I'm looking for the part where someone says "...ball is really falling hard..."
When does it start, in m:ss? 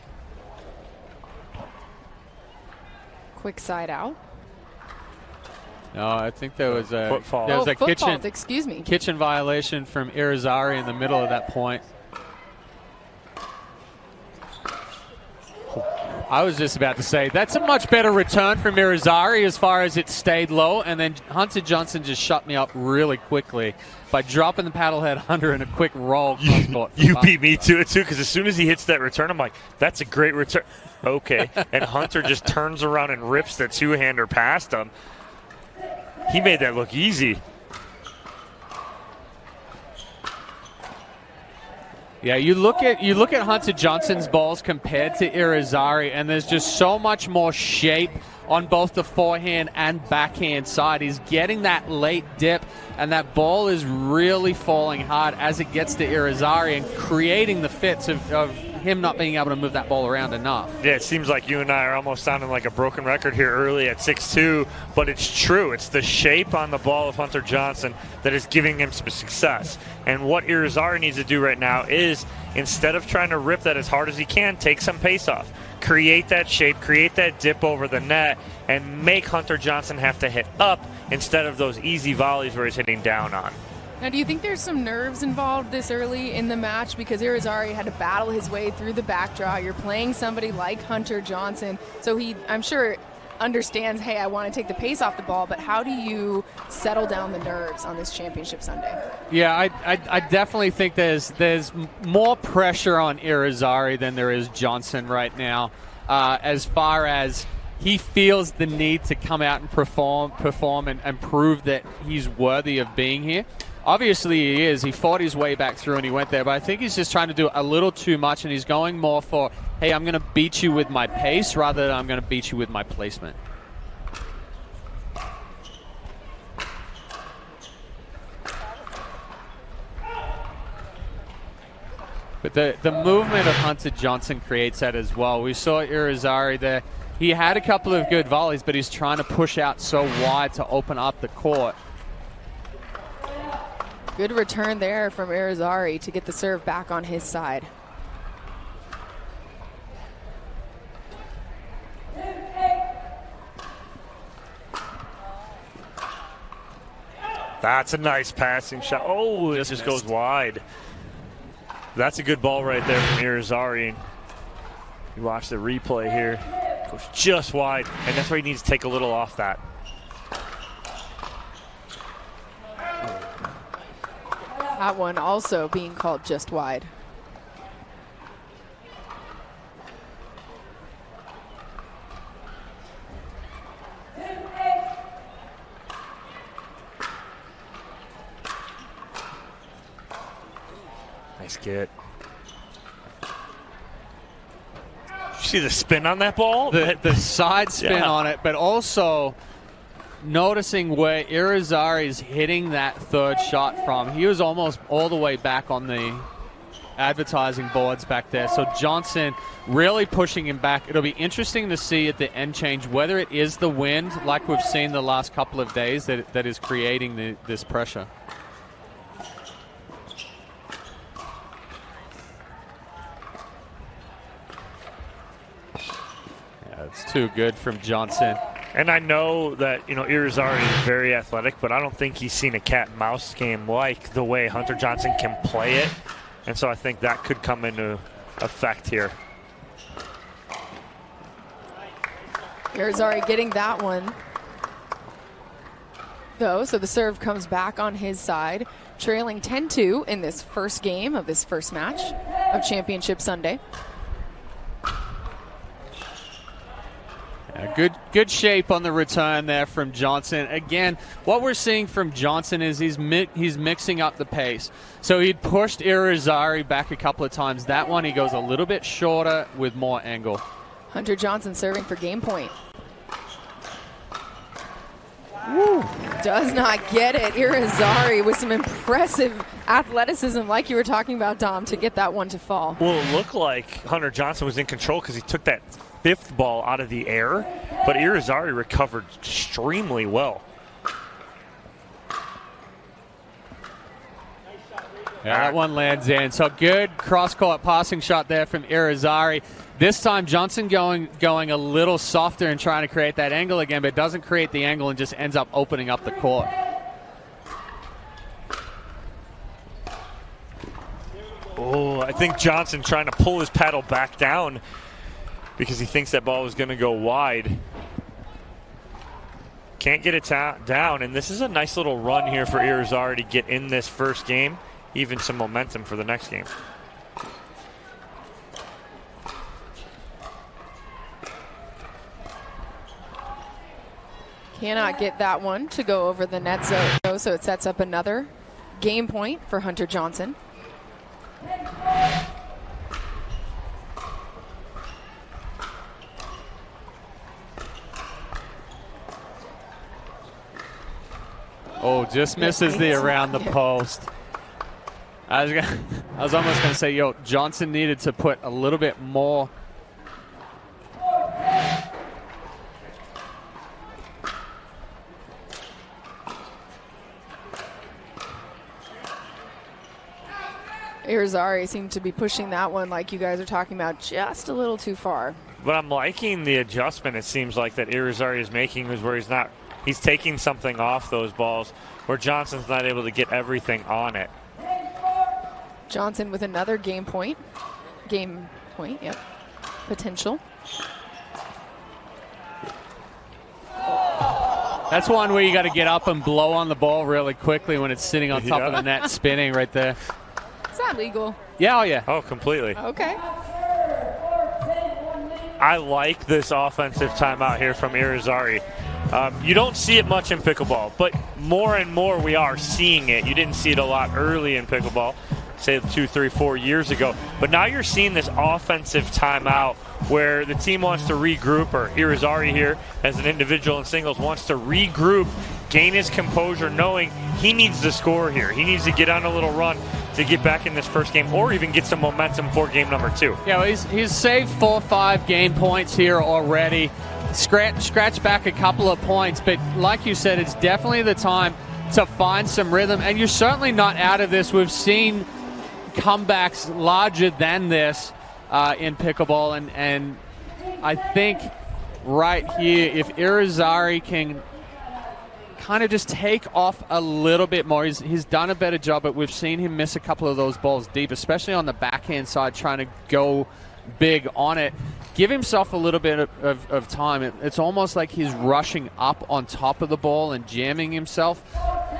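0:53.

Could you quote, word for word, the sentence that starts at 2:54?
That one also being called just wide.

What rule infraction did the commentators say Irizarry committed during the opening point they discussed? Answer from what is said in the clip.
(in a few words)
Kitchen violation.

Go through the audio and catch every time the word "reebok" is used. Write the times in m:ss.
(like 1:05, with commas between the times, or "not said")
not said.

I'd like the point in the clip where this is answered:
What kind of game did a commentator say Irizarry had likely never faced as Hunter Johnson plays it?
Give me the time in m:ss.
3:52.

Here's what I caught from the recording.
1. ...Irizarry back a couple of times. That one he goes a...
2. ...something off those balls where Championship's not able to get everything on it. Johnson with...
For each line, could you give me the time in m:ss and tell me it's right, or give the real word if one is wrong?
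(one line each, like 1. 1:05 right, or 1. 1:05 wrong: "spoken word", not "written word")
1. 4:25 right
2. 6:20 wrong: "Johnson", not "Championship".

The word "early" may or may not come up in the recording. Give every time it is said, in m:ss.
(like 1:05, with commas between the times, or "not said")
1:03, 1:25, 6:54.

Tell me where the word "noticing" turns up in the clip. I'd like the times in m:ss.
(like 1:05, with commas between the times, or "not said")
3:20.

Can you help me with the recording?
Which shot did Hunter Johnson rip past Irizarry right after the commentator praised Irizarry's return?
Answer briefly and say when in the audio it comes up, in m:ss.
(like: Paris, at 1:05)
the two-hander, at 0:33.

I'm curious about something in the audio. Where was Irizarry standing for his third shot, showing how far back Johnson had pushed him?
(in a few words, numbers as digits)
advertising boards.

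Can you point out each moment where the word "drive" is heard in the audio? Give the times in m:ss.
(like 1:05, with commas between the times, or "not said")
not said.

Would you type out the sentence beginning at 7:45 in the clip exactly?
Give himself a little bit of, of, of time.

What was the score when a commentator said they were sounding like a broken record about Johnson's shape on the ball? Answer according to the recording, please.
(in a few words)
6-2.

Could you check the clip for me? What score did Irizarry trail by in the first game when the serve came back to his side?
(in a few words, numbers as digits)
10-2.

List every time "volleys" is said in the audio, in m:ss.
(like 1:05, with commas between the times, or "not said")
1:22, 2:18.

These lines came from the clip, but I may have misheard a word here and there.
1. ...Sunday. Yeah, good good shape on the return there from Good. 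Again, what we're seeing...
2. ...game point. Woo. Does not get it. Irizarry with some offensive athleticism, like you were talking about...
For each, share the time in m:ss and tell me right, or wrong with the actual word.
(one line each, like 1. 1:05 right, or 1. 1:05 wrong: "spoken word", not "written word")
1. 4:13 wrong: "Johnson", not "Good"
2. 4:31 wrong: "impressive", not "offensive".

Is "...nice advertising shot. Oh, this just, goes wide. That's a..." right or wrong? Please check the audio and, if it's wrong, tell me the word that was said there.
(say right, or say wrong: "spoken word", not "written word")
wrong: "passing", not "advertising".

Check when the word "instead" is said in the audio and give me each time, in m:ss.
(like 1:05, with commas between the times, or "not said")
1:12, 1:21.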